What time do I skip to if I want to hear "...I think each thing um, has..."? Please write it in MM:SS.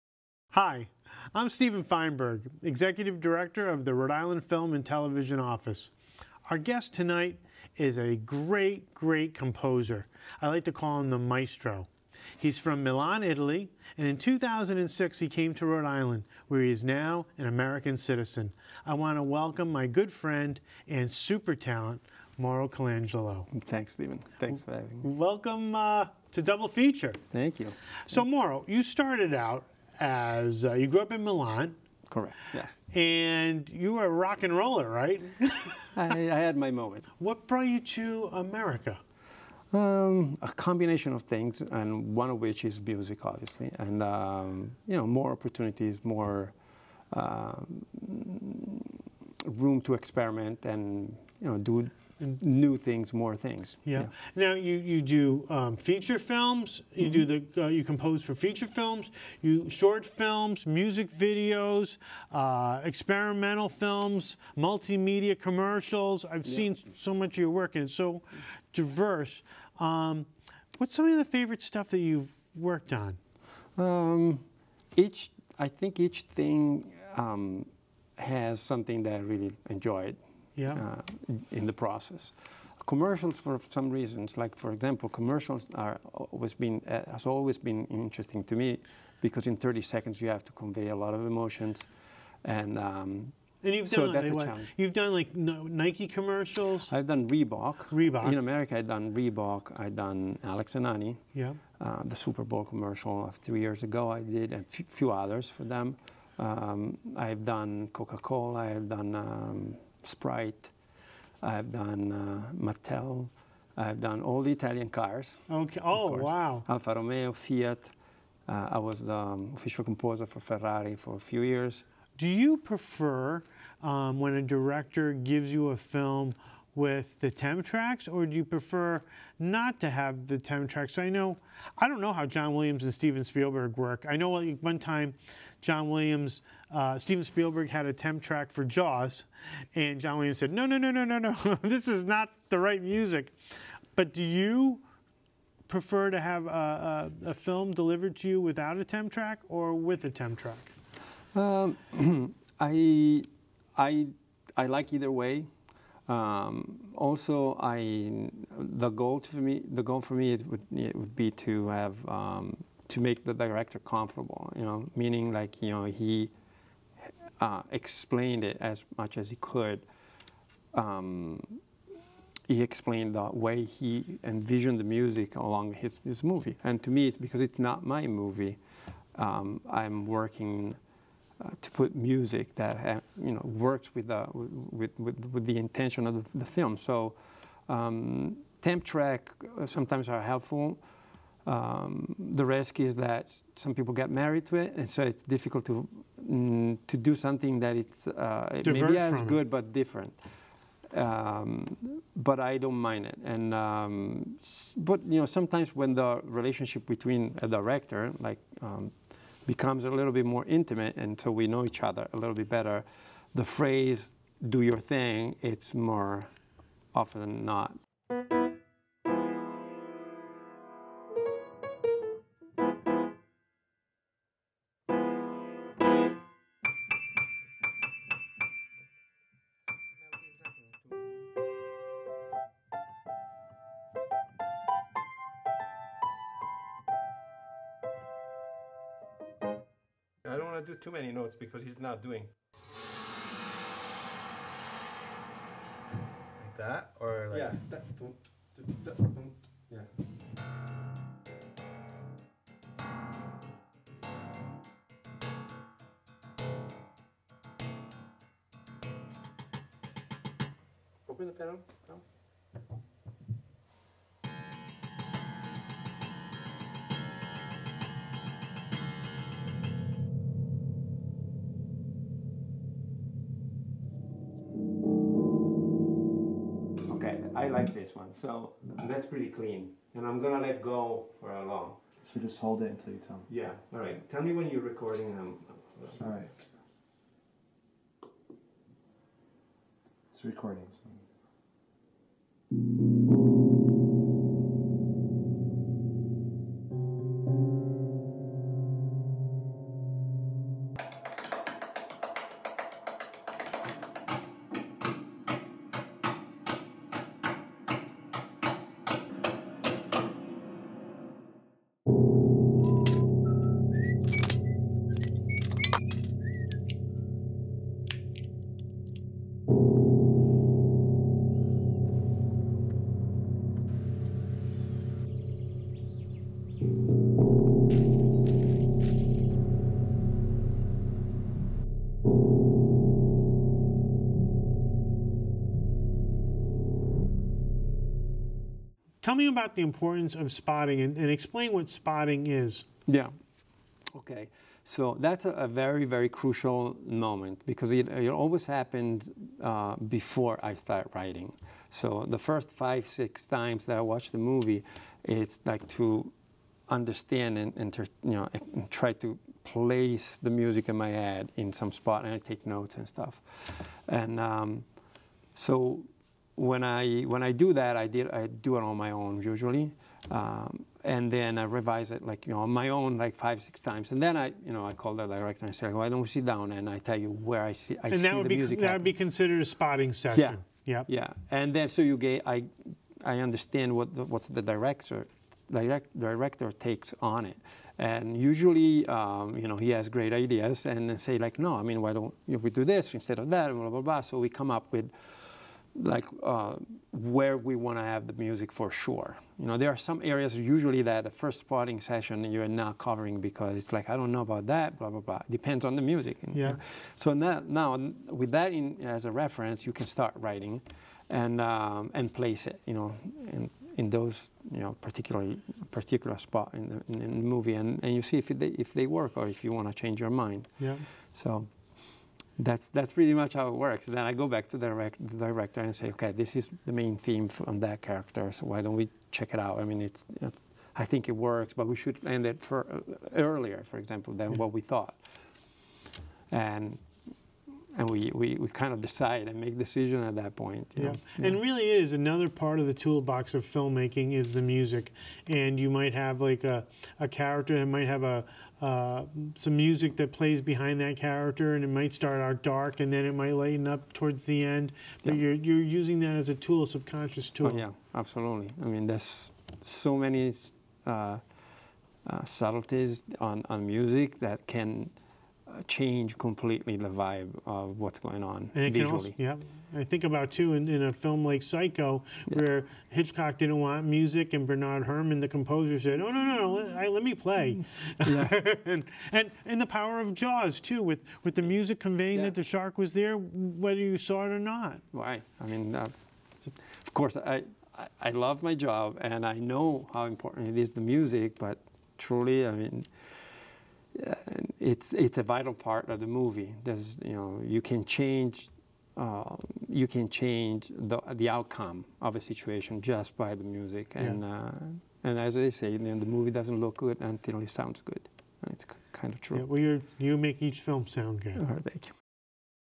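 01:15.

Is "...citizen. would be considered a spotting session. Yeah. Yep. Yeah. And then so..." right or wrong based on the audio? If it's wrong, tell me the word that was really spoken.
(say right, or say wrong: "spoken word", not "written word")
wrong: "happen", not "citizen".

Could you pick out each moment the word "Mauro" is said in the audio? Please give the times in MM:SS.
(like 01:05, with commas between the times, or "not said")
00:22, 00:28.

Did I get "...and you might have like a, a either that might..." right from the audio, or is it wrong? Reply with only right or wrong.
wrong.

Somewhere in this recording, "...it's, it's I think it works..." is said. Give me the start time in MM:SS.
07:09.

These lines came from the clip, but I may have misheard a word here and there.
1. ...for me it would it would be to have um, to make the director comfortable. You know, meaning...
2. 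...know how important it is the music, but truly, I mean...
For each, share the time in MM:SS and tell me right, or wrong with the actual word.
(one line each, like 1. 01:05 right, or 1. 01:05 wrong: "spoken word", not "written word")
1. 02:40 right
2. 08:09 right.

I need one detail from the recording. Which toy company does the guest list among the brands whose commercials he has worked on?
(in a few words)
Mattel.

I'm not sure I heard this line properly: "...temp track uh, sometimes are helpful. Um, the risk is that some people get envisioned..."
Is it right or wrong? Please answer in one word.
wrong.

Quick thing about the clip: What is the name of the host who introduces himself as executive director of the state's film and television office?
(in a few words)
Stephen Feinberg.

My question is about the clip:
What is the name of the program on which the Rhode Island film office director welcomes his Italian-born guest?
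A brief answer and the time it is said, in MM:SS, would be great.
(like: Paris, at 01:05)
Double Feature, at 00:26.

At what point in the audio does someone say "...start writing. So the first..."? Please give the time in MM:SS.
05:50.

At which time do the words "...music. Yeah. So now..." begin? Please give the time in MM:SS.
06:45.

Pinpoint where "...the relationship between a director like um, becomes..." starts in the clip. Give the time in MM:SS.
03:25.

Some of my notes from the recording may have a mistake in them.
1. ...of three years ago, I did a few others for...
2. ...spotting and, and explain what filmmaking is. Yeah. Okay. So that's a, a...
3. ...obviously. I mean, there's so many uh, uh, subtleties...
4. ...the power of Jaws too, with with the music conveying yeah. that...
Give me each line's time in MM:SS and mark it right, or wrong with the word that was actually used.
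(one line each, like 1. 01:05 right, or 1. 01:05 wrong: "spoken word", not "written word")
1. 01:43 right
2. 05:40 wrong: "spotting", not "filmmaking"
3. 07:37 wrong: "absolutely", not "obviously"
4. 07:59 right.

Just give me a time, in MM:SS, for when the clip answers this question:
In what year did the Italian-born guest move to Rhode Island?
00:14.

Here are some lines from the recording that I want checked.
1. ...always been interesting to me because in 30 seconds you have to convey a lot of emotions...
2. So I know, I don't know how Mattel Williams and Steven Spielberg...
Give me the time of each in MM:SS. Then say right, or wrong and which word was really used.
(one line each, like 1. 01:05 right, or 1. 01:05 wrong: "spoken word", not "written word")
1. 01:27 right
2. 02:10 wrong: "John", not "Mattel".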